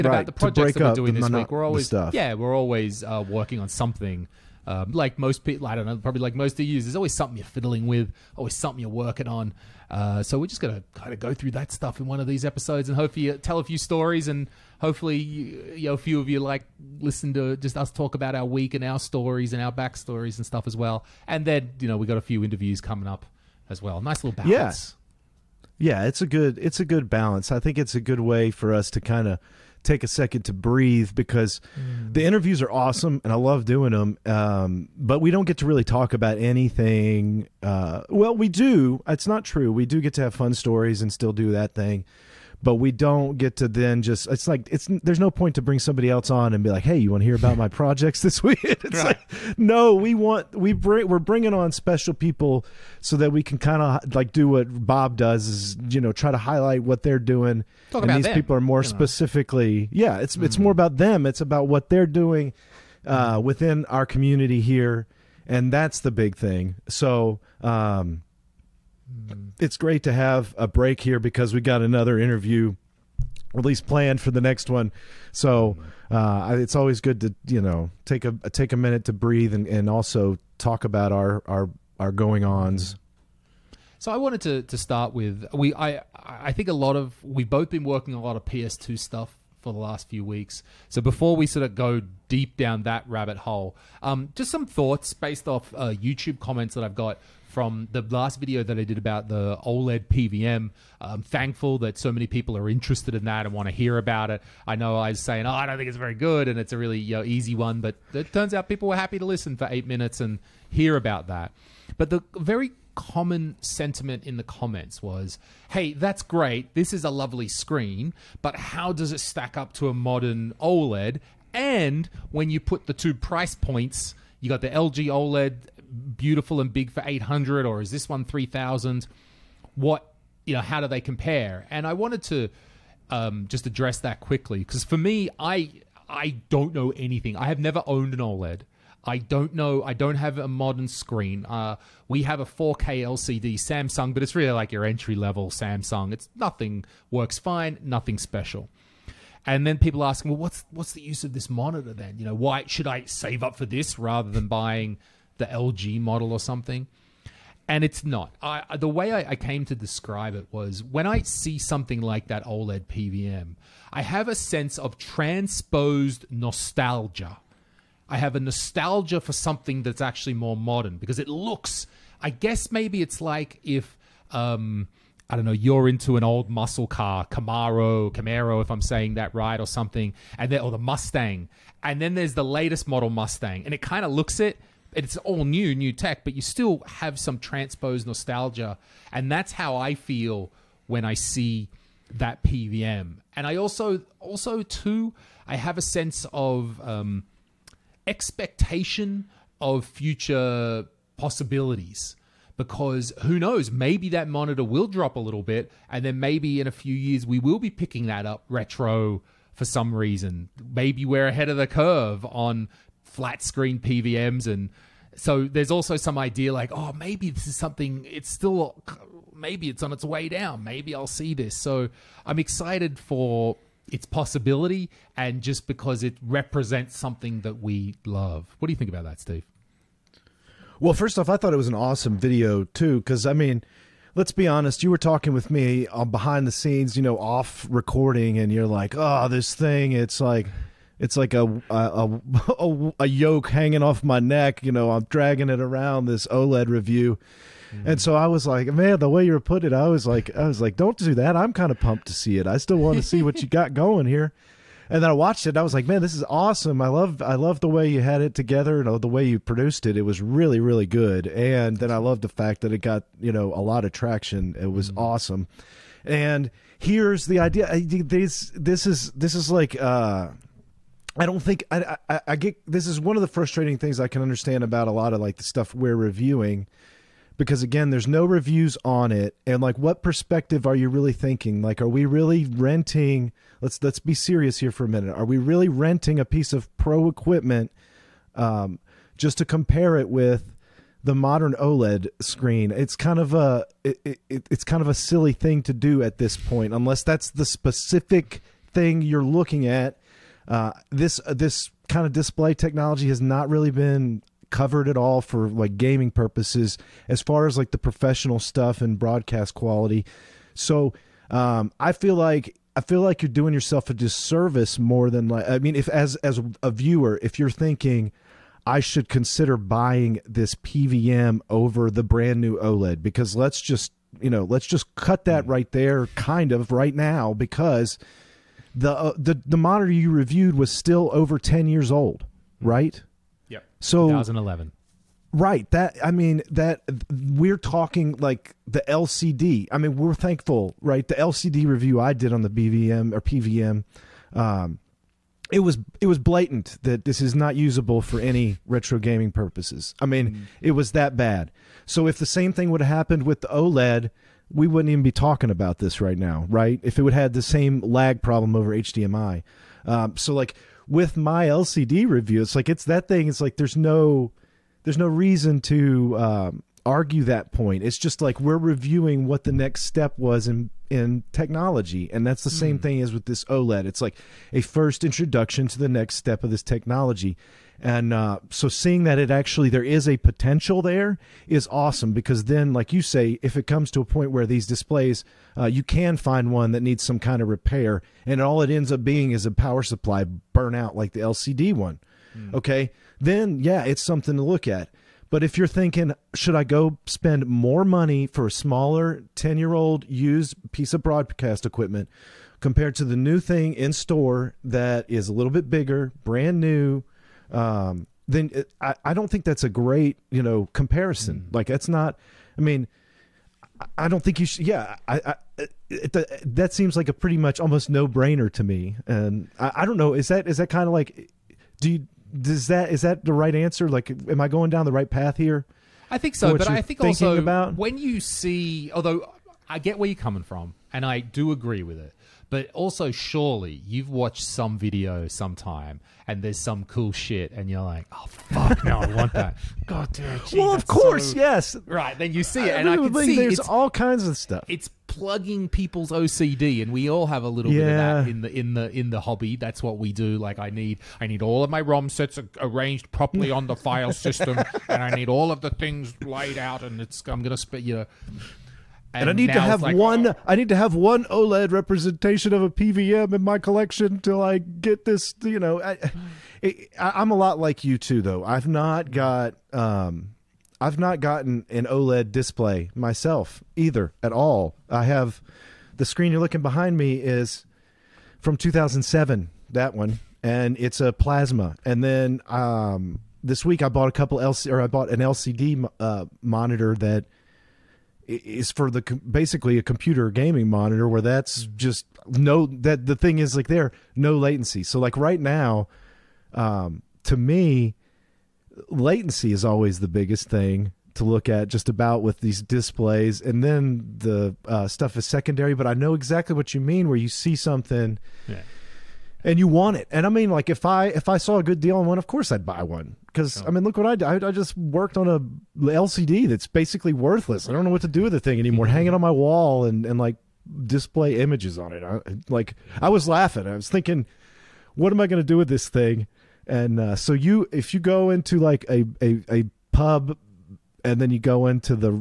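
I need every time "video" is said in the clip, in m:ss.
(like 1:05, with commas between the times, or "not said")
1:38, 3:52, 7:14.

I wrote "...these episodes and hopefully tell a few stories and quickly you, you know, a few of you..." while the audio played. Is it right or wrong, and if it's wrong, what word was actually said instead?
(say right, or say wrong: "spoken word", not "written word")
wrong: "hopefully", not "quickly".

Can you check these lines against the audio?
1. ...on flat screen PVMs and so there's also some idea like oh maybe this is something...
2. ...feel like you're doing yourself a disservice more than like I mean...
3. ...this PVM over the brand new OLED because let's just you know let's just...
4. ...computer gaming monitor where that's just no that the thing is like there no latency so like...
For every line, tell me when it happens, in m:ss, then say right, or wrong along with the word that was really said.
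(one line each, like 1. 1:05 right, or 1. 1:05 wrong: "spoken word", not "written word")
1. 3:32 right
2. 5:12 right
3. 5:20 right
4. 8:09 right.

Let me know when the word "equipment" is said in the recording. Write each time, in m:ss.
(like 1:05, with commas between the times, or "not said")
4:47, 6:41.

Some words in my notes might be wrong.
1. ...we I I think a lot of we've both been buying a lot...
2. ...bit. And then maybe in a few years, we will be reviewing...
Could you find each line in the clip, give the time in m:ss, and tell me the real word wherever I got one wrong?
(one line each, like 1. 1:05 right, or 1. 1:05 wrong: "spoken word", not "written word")
1. 1:25 wrong: "working", not "buying"
2. 3:25 wrong: "picking", not "reviewing".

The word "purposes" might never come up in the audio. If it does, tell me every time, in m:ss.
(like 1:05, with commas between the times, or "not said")
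5:06, 5:49.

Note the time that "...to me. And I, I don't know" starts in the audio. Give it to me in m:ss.
6:58.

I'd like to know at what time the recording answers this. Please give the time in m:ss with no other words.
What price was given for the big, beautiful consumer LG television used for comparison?
2:07.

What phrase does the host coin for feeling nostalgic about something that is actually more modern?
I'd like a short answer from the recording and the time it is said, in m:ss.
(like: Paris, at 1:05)
transposed nostalgia, at 2:44.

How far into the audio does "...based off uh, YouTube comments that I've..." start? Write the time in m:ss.
1:35.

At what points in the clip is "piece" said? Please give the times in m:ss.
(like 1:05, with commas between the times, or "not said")
4:46, 6:40.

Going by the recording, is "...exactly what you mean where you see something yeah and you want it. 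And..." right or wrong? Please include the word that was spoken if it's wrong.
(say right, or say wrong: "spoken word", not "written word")
right.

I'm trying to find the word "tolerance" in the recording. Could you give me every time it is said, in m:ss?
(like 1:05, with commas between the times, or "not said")
not said.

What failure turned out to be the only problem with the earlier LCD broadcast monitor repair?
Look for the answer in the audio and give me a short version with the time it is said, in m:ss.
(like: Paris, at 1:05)
power supply burnout, at 6:29.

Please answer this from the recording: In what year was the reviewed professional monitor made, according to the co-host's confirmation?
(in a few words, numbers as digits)
2011.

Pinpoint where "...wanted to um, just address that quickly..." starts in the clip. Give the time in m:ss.
2:11.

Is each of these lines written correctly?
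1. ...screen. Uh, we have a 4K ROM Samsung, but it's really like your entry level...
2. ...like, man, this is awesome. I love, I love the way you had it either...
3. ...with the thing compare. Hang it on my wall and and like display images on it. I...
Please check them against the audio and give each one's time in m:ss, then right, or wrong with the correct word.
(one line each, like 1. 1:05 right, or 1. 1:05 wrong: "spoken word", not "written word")
1. 2:20 wrong: "LCD", not "ROM"
2. 4:15 wrong: "together", not "either"
3. 8:38 wrong: "anymore", not "compare".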